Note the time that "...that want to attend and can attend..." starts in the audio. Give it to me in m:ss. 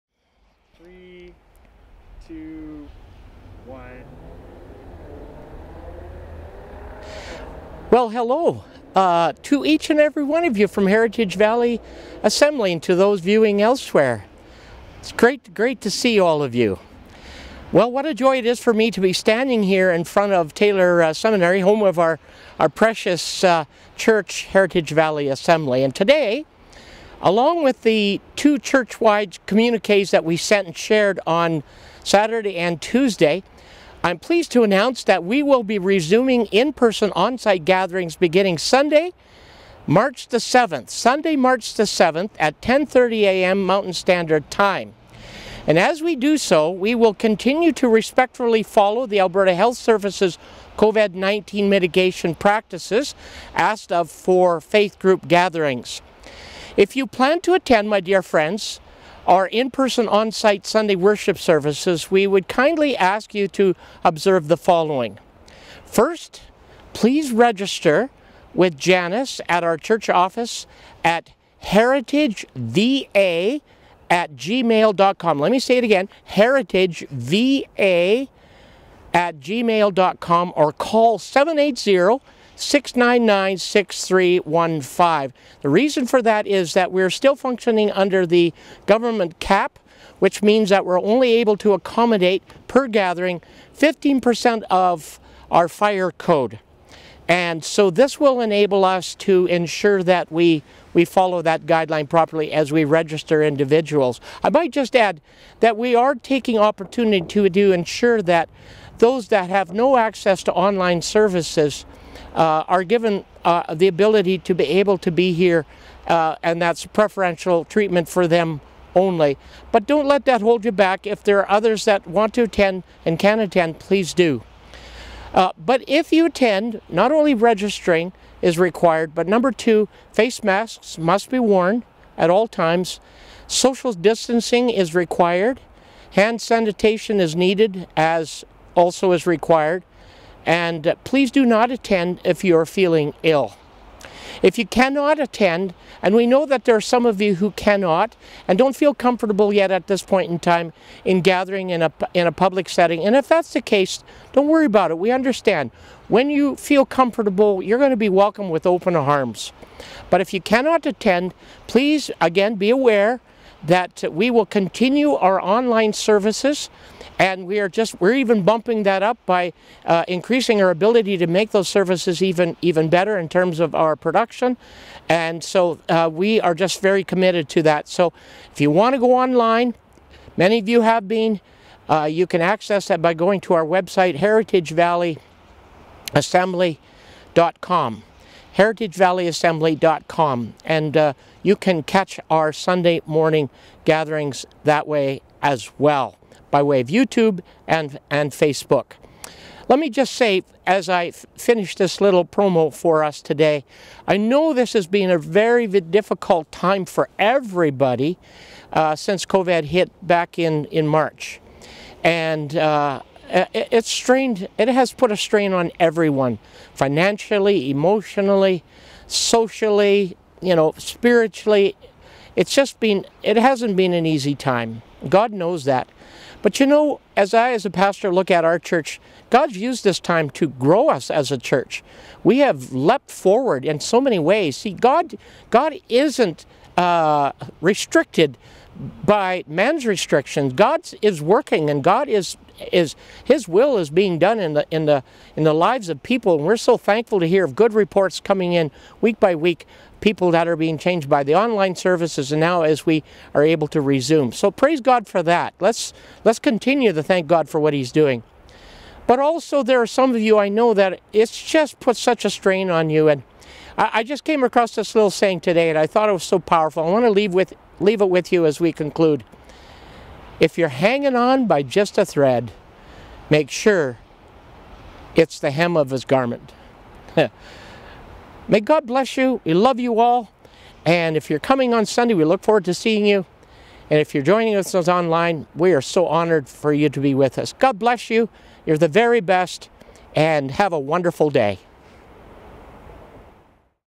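2:01.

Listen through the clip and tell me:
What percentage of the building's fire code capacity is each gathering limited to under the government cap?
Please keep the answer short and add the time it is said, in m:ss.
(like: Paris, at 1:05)
15%, at 1:33.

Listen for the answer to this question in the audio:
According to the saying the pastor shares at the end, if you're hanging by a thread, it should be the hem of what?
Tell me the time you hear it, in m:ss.
4:35.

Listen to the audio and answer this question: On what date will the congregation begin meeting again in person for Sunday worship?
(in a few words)
March 7.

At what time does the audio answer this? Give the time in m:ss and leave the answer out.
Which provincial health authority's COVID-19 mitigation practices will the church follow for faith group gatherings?
0:49.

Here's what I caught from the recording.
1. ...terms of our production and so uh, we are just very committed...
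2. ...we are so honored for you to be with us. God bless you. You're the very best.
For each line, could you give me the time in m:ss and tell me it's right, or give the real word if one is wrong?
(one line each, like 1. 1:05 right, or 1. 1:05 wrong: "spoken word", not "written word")
1. 2:53 right
2. 4:45 right.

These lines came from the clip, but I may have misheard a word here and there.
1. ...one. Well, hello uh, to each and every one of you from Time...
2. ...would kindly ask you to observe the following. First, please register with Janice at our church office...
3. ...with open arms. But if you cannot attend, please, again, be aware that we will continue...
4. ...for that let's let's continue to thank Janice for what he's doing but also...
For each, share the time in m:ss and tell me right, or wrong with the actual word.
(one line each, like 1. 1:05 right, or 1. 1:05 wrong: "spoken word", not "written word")
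1. 0:03 wrong: "Heritage", not "Time"
2. 1:02 right
3. 2:38 right
4. 4:15 wrong: "God", not "Janice".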